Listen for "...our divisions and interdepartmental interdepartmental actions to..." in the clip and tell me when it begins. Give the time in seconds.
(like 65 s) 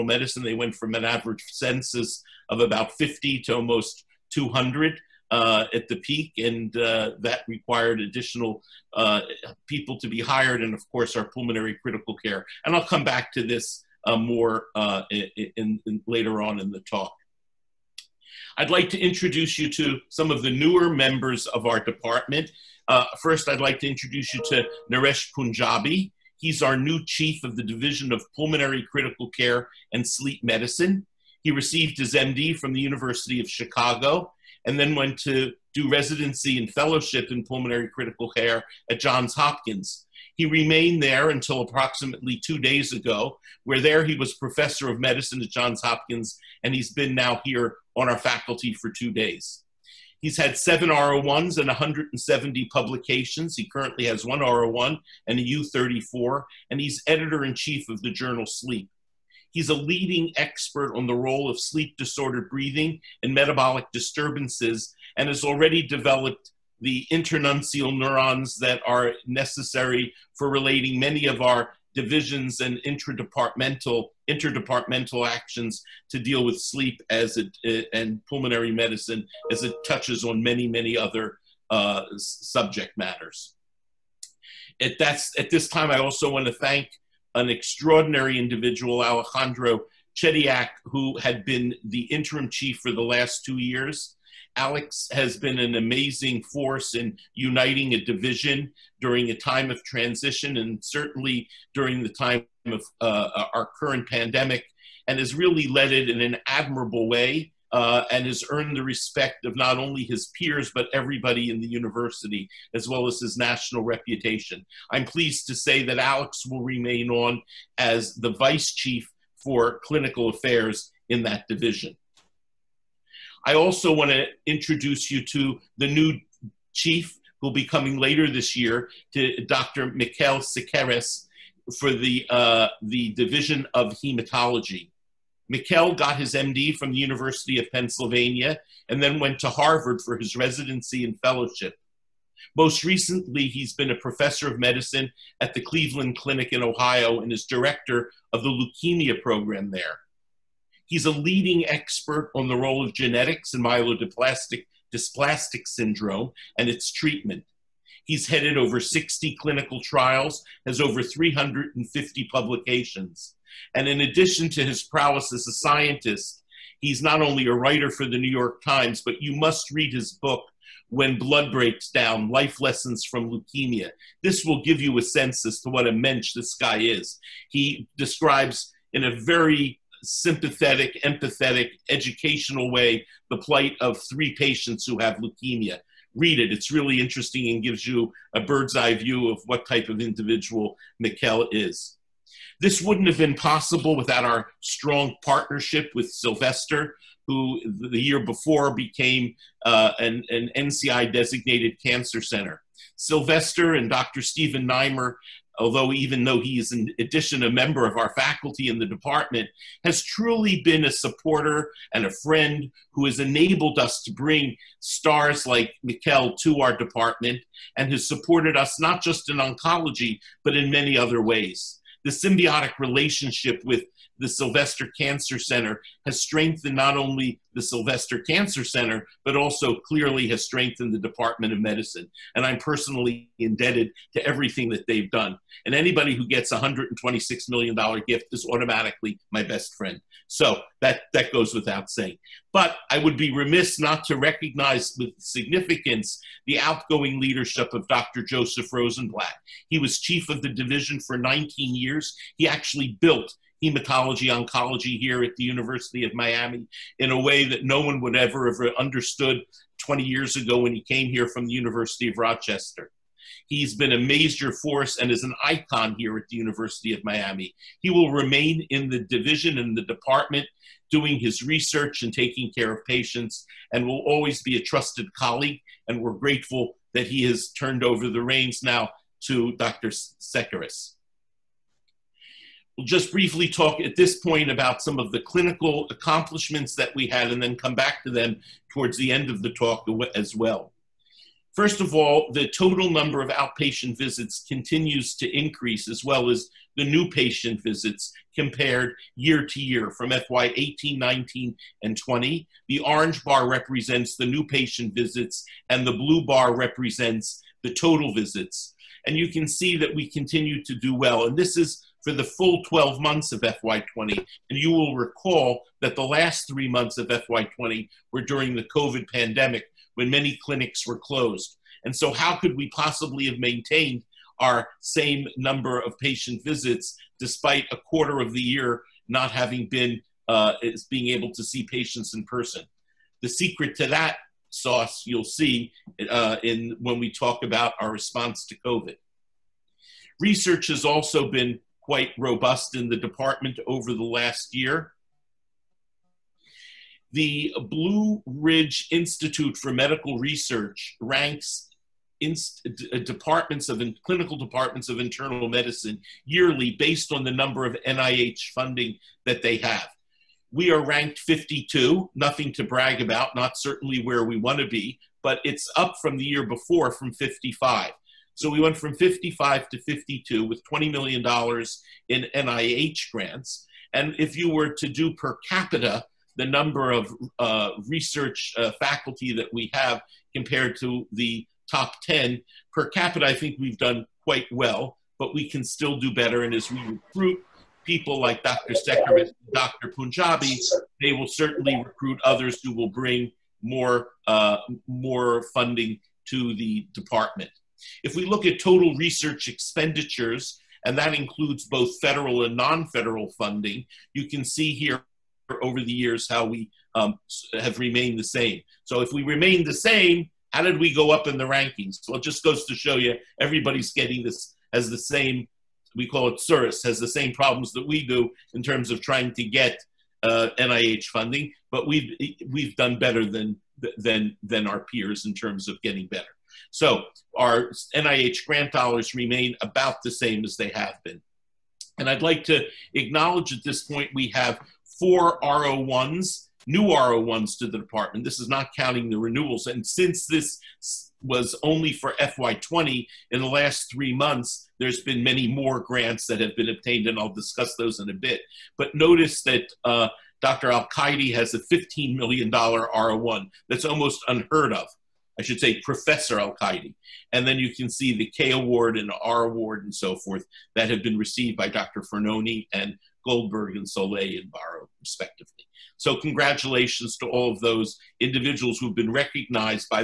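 71 s.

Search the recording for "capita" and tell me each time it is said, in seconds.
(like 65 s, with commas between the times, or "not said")
375 s, 382 s.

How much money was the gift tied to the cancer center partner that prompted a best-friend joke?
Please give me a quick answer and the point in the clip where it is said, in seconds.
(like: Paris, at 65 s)
$126 million, at 236 s.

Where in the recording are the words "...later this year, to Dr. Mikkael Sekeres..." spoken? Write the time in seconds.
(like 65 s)
127 s.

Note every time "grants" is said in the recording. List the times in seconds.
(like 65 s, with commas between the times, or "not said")
373 s, 428 s, 445 s.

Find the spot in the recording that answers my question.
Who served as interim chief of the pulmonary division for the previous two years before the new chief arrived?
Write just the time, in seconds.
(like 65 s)
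89 s.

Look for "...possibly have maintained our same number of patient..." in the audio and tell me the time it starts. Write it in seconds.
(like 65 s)
322 s.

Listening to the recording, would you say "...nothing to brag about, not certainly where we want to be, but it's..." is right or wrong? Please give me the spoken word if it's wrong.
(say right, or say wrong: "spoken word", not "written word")
right.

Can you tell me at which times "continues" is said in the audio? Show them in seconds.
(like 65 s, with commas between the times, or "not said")
294 s, 310 s.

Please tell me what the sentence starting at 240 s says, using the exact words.
So that, that goes without saying.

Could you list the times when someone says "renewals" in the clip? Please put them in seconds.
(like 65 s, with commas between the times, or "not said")
439 s.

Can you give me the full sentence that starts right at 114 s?
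I'm pleased to say that Alex will remain on as the vice chief for clinical affairs in that division.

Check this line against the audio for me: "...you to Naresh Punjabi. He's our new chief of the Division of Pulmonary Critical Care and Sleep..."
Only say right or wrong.
right.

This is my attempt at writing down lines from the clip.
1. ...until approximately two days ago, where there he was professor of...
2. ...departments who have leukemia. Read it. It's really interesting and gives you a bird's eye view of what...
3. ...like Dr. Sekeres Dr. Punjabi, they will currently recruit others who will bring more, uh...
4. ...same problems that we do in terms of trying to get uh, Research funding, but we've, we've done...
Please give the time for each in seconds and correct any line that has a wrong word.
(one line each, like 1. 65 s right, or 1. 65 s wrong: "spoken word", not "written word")
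1. 41 s right
2. 184 s wrong: "patients", not "departments"
3. 388 s wrong: "certainly", not "currently"
4. 417 s wrong: "NIH", not "Research".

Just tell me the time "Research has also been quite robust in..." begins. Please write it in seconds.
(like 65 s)
340 s.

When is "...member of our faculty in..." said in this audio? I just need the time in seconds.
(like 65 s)
207 s.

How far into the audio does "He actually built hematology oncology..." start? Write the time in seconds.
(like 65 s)
252 s.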